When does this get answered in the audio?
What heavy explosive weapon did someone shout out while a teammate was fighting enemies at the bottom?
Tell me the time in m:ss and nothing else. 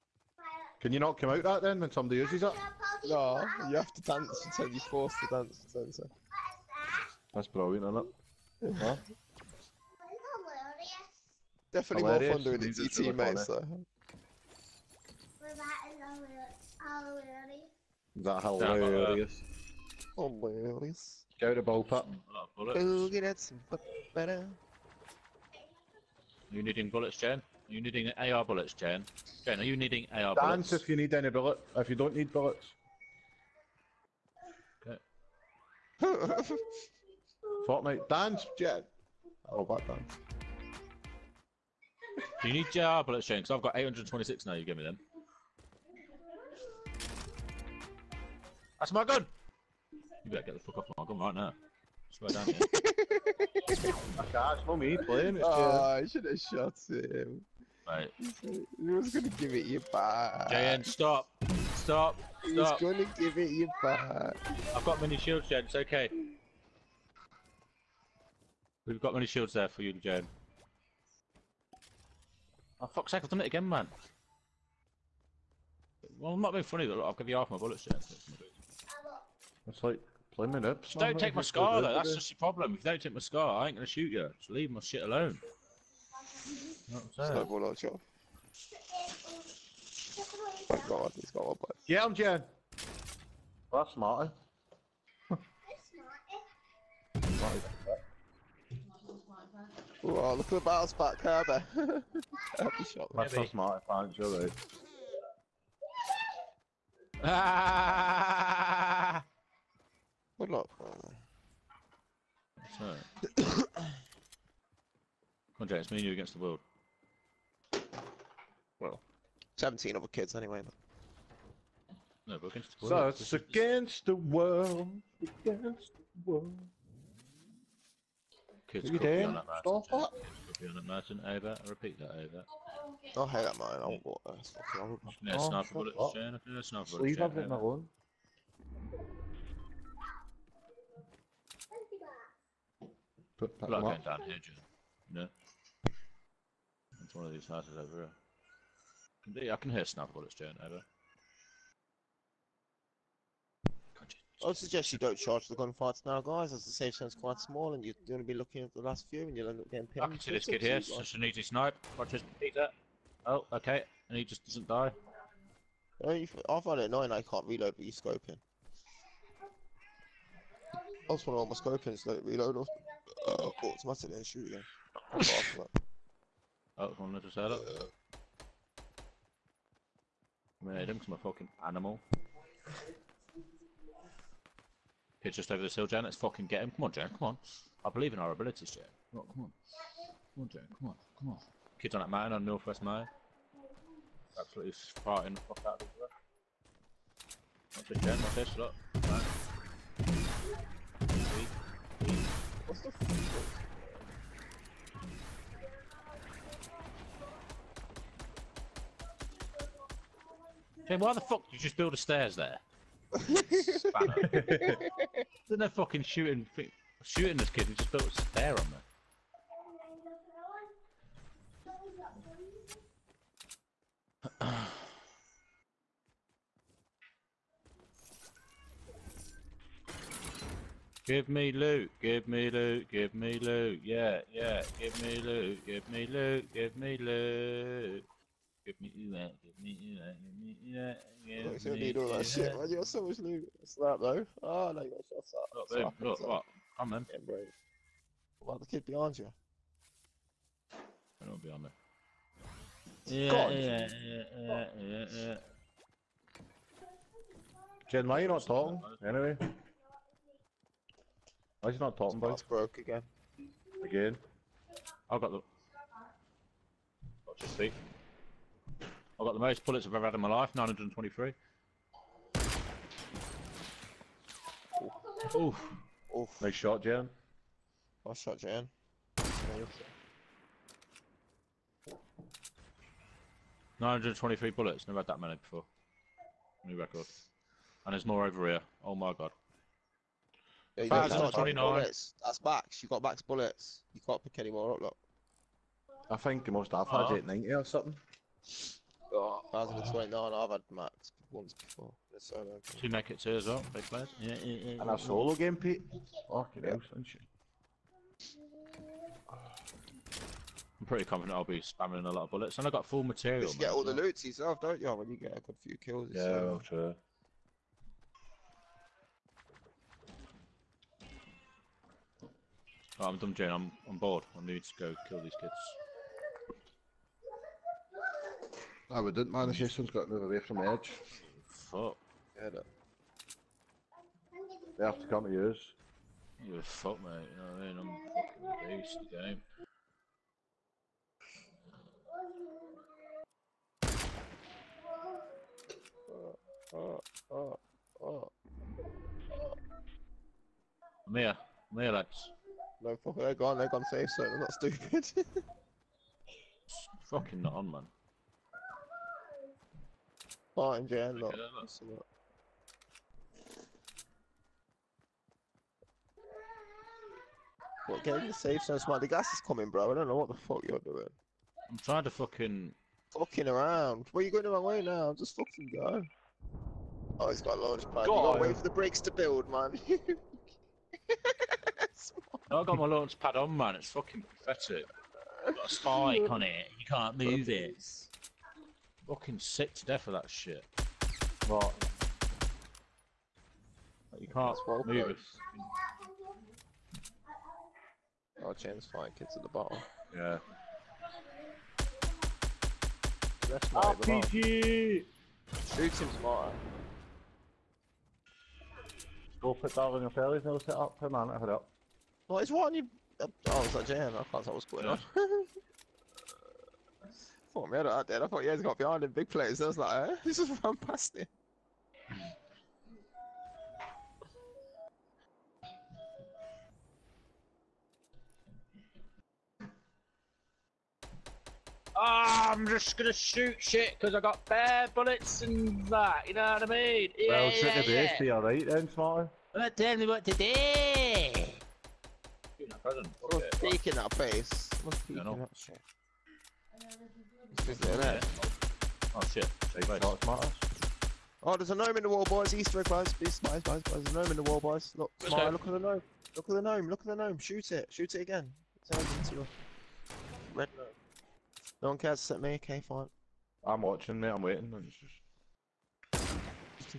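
6:43.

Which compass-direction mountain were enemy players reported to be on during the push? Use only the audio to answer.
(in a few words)
Northwest Mountain.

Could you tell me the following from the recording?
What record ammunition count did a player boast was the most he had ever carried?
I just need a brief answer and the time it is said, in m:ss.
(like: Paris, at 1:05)
923, at 4:30.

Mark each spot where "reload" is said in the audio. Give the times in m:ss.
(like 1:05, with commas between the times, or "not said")
2:47, 2:52.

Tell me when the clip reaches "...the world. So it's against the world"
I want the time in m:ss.
2:02.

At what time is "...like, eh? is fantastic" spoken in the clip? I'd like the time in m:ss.
6:59.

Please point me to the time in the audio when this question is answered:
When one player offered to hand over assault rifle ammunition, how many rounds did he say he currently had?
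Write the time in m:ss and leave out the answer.
0:43.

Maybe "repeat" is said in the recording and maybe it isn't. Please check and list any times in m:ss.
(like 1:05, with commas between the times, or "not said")
2:11.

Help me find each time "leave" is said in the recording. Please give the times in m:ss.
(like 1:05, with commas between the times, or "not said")
1:24, 2:16.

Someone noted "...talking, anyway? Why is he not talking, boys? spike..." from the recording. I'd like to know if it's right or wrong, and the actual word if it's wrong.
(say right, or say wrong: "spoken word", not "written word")
wrong: "broke", not "spike".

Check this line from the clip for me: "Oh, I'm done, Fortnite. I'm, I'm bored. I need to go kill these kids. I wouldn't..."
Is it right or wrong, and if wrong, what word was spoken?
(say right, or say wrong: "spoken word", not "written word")
wrong: "Jane", not "Fortnite".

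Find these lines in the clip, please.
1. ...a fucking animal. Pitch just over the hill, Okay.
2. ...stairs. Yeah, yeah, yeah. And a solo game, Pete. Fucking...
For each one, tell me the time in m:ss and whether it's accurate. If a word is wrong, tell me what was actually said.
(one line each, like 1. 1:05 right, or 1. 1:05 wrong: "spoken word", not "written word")
1. 3:01 wrong: "Jan", not "Okay"
2. 5:03 wrong: "players", not "stairs".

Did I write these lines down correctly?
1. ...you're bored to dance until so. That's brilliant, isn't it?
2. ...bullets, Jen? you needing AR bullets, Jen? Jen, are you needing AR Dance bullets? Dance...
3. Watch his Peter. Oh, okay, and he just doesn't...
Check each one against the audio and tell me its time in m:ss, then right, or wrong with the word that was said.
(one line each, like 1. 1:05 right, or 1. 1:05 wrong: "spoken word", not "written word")
1. 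0:04 wrong: "forced", not "bored"
2. 0:26 right
3. 2:41 right.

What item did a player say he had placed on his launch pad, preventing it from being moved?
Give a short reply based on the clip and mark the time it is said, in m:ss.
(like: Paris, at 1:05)
spike, at 6:25.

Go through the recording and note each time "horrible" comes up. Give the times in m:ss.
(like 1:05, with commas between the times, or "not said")
2:14.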